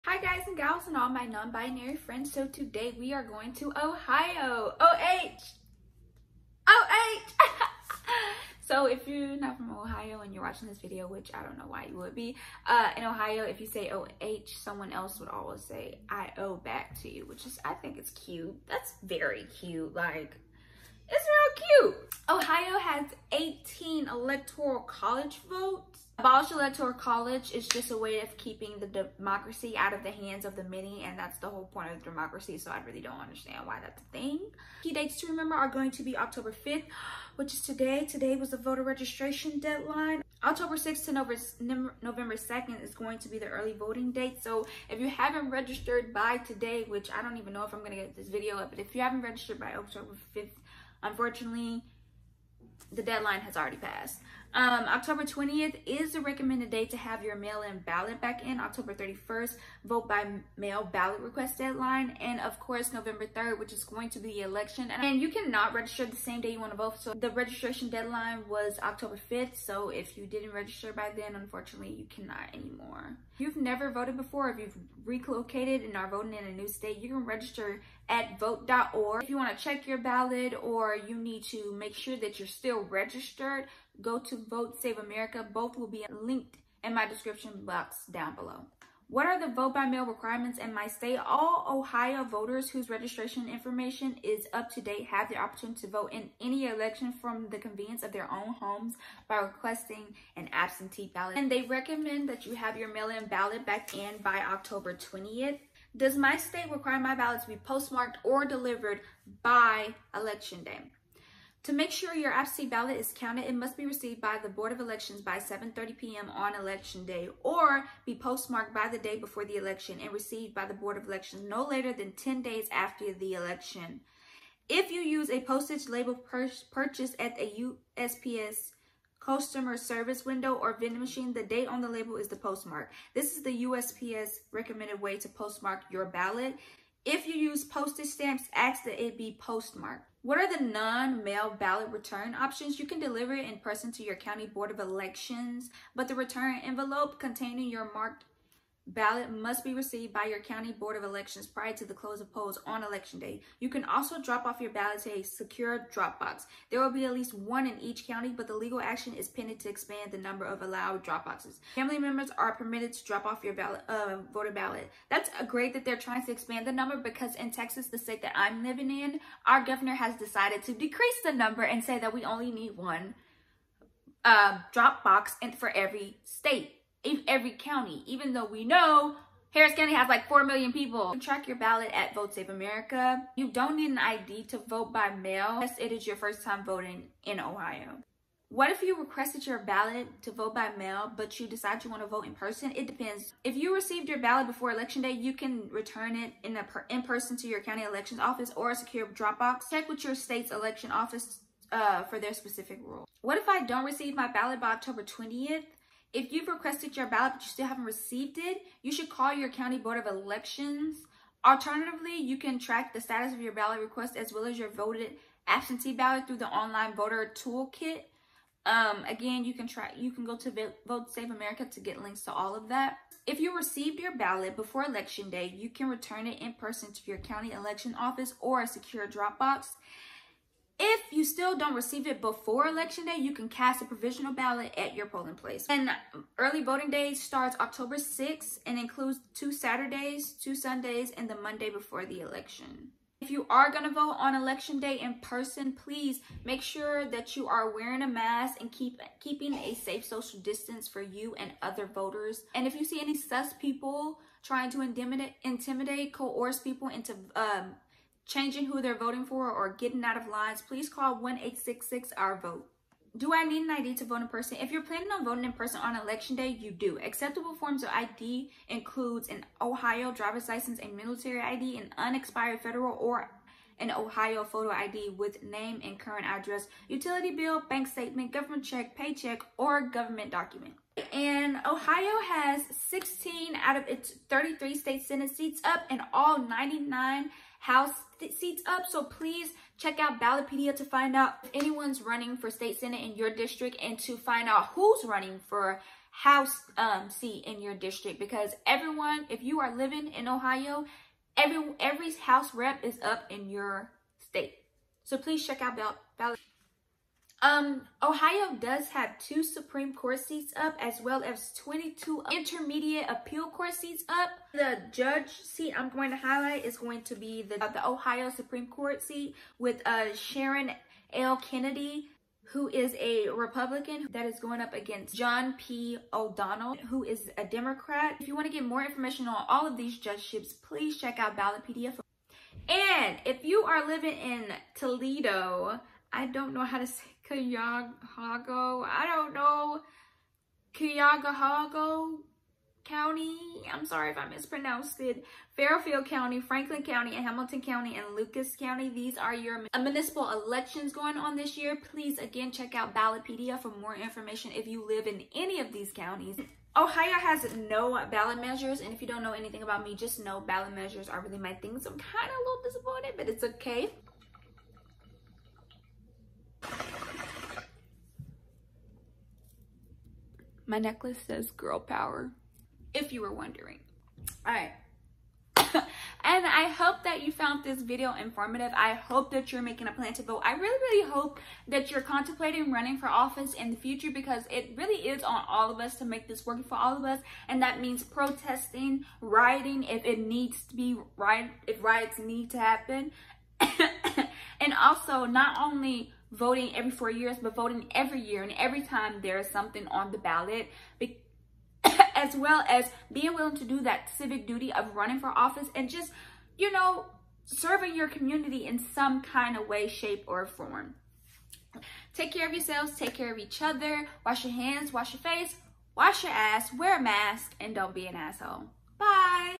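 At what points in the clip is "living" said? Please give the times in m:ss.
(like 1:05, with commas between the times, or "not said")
2:48, 4:59, 5:33.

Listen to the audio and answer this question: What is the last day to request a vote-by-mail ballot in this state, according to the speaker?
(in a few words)
October 31st.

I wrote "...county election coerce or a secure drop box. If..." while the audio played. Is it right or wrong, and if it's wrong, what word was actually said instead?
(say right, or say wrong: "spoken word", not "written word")
wrong: "office", not "coerce".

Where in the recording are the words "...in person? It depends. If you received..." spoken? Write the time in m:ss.
3:12.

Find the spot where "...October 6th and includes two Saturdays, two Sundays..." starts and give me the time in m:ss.
3:57.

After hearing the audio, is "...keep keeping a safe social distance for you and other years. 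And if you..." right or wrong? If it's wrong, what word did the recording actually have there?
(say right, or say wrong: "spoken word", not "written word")
wrong: "voters", not "years".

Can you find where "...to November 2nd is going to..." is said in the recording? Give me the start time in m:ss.
0:41.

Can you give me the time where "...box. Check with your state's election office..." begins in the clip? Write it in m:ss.
3:19.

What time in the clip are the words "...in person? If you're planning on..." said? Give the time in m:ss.
4:24.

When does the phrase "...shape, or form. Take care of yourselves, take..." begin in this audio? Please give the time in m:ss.
6:49.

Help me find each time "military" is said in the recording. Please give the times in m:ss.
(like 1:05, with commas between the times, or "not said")
4:30.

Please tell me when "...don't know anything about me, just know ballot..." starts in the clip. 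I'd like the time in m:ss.
5:59.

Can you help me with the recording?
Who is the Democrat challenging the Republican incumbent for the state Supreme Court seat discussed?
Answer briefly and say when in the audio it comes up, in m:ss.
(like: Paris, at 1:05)
John P. O'Donnell, at 5:25.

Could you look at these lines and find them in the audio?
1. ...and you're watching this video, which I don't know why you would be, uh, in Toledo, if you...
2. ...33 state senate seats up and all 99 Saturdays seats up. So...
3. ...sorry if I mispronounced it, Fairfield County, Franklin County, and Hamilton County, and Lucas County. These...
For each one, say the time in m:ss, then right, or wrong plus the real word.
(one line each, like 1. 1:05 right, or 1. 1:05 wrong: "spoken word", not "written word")
1. 0:10 wrong: "Ohio", not "Toledo"
2. 4:44 wrong: "House", not "Saturdays"
3. 5:43 right.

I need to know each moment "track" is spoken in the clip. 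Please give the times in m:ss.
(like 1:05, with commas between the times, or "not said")
3:01, 3:32.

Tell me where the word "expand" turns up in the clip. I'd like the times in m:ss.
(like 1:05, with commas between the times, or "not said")
2:39, 2:46.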